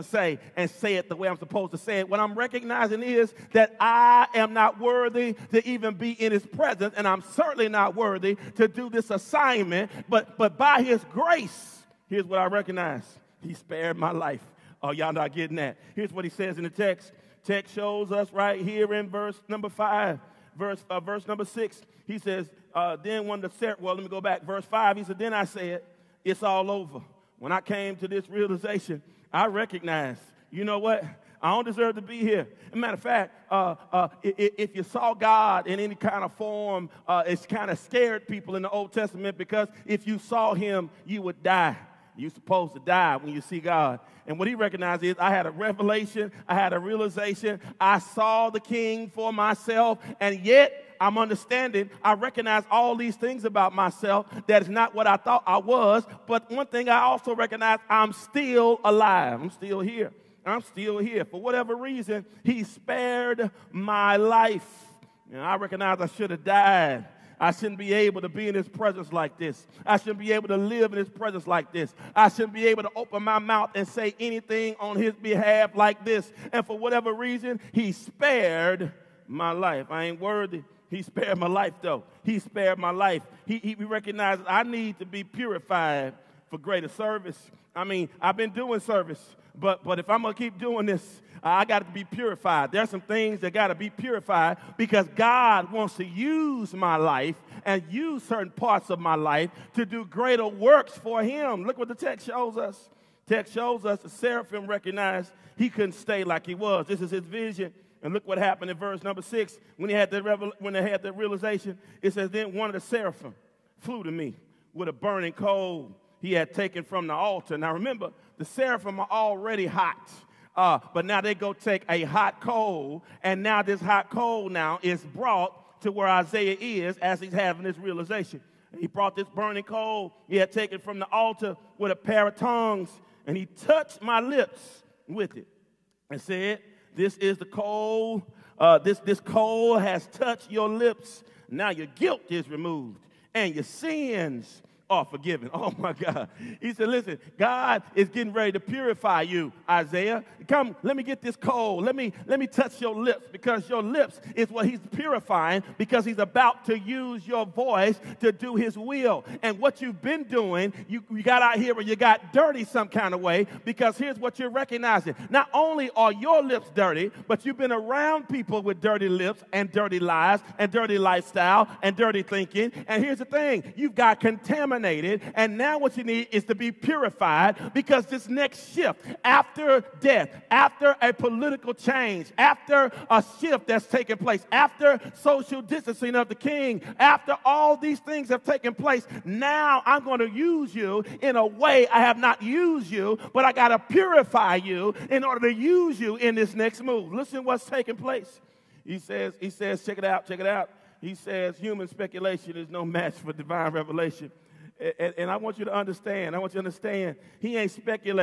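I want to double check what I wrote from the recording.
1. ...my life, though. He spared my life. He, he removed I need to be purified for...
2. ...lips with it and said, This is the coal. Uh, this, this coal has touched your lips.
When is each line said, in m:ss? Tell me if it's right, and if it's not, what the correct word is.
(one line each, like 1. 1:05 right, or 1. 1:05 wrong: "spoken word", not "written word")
1. 1:21 wrong: "recognized", not "removed"
2. 2:14 right.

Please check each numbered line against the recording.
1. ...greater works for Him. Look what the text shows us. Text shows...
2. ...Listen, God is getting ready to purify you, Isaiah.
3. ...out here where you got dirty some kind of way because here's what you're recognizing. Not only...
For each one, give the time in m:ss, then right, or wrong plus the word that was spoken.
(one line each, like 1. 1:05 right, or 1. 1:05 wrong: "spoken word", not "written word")
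1. 1:40 right
2. 2:26 right
3. 2:41 right.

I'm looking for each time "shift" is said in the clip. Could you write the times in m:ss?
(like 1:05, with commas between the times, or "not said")
2:58, 3:03.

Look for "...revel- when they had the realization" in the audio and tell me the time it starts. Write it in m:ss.
1:50.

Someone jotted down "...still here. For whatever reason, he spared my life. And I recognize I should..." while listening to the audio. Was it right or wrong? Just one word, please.
right.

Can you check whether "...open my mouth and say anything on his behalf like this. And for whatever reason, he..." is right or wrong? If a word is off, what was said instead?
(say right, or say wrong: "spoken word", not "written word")
right.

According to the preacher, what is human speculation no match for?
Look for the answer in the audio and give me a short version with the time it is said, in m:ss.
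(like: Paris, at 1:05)
divine revelation, at 3:23.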